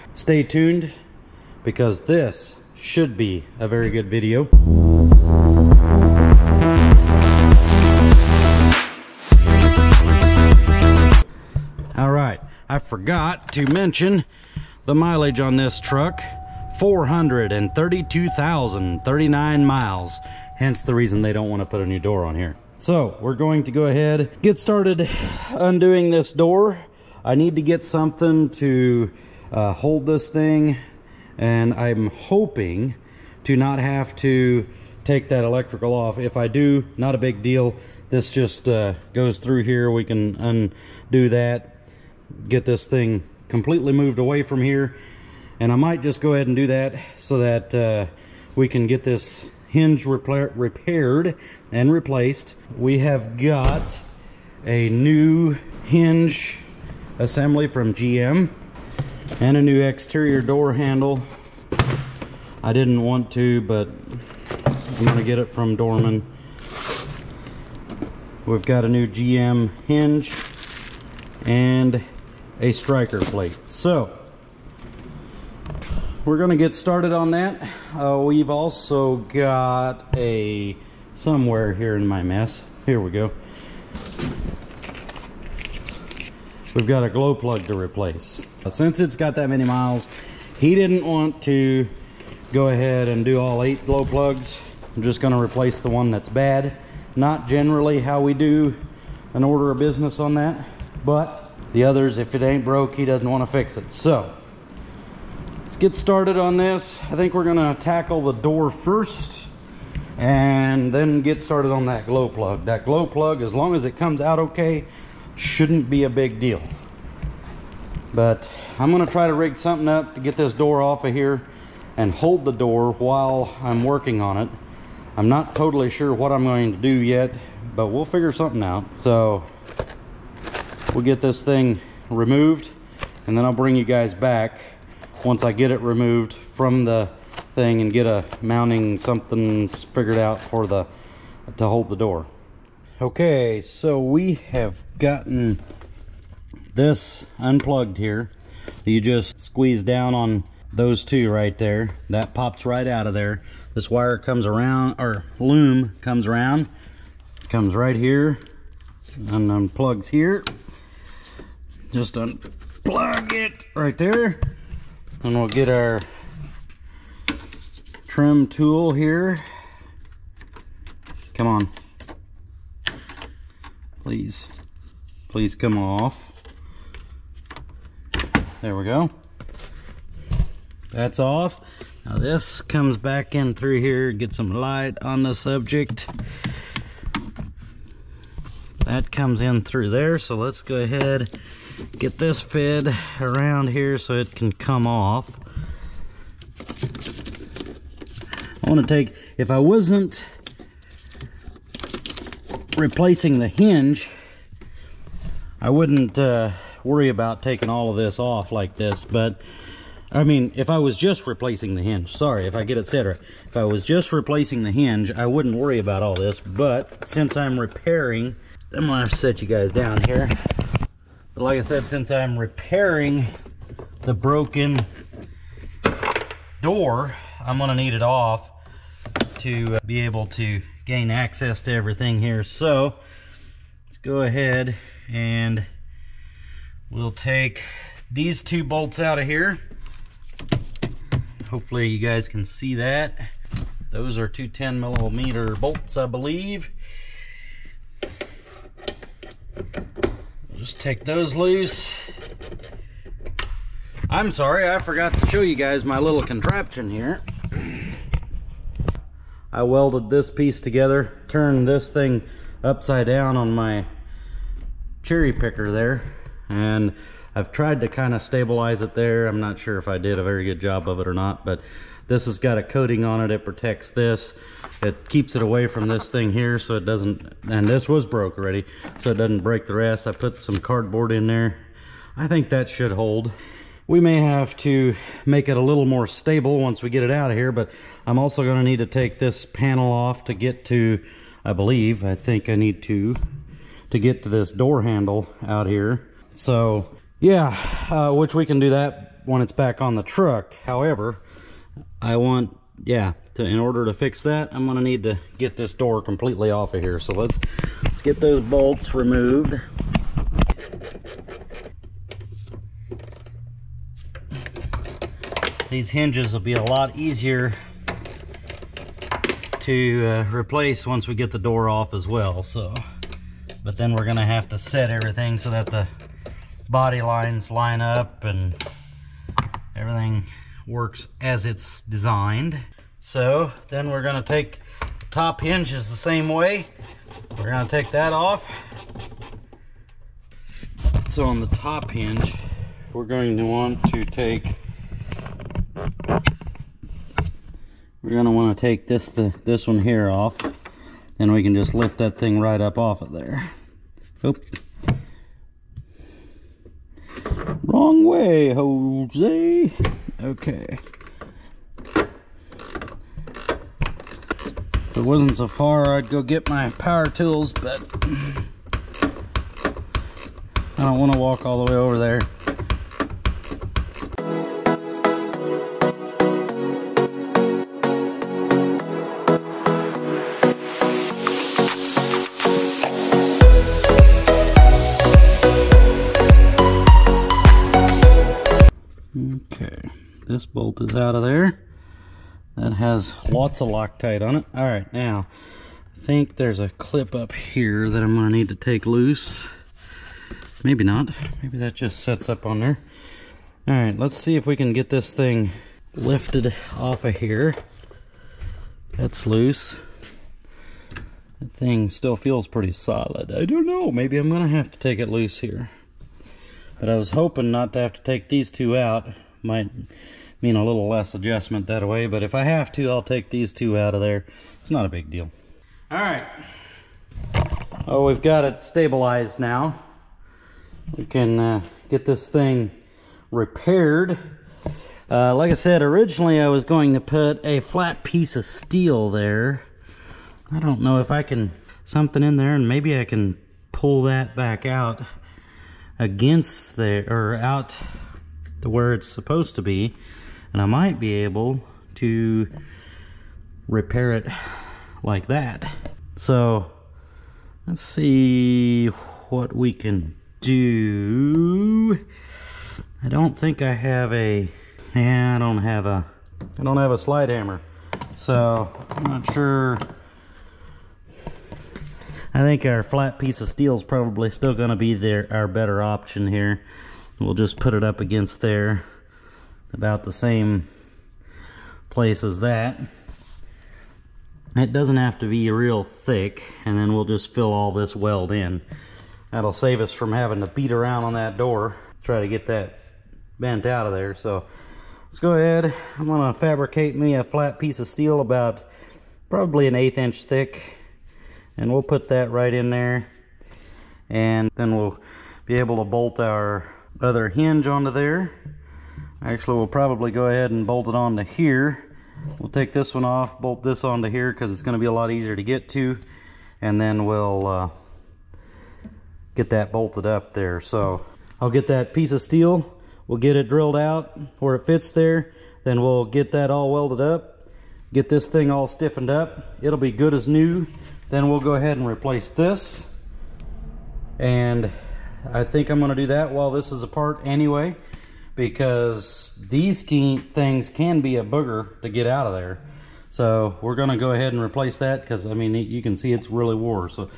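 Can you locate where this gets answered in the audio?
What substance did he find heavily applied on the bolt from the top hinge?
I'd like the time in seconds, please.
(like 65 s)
393 s.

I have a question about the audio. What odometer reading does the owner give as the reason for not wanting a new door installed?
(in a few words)
432,039 miles.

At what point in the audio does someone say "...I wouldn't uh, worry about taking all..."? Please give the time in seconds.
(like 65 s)
205 s.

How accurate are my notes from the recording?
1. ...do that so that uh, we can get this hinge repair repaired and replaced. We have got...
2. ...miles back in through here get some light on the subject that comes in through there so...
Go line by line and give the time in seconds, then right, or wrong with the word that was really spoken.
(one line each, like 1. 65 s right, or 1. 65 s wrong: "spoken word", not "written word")
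1. 46 s right
2. 182 s wrong: "comes", not "miles".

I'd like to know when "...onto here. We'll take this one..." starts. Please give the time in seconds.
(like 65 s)
510 s.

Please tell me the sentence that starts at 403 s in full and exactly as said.
All right, let's see if we can get this thing lifted off of here.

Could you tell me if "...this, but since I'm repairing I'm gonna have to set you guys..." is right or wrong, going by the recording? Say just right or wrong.
right.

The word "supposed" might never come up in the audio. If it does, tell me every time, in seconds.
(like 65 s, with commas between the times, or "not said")
449 s.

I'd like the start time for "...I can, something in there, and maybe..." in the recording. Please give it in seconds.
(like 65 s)
441 s.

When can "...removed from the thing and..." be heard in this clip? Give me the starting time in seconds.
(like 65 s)
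135 s.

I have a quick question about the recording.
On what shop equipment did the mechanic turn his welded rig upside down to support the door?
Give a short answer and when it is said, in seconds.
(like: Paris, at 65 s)
cherry picker, at 265 s.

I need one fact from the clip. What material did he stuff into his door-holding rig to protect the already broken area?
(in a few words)
cardboard.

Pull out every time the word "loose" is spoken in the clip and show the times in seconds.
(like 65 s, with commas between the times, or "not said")
251 s, 398 s, 409 s, 415 s.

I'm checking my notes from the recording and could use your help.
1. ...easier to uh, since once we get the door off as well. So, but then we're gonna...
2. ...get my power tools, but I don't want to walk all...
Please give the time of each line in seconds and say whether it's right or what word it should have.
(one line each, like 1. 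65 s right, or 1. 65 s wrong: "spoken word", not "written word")
1. 316 s wrong: "replace", not "since"
2. 366 s right.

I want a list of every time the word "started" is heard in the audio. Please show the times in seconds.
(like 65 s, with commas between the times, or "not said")
24 s, 76 s, 105 s, 111 s.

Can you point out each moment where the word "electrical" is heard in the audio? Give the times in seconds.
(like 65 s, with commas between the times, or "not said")
35 s.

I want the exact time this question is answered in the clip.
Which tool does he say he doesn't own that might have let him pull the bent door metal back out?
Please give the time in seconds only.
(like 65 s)
466 s.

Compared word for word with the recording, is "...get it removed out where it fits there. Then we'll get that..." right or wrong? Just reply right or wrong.
wrong.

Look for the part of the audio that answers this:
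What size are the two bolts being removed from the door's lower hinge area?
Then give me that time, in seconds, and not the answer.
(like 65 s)
244 s.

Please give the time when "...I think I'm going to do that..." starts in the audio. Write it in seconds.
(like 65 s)
535 s.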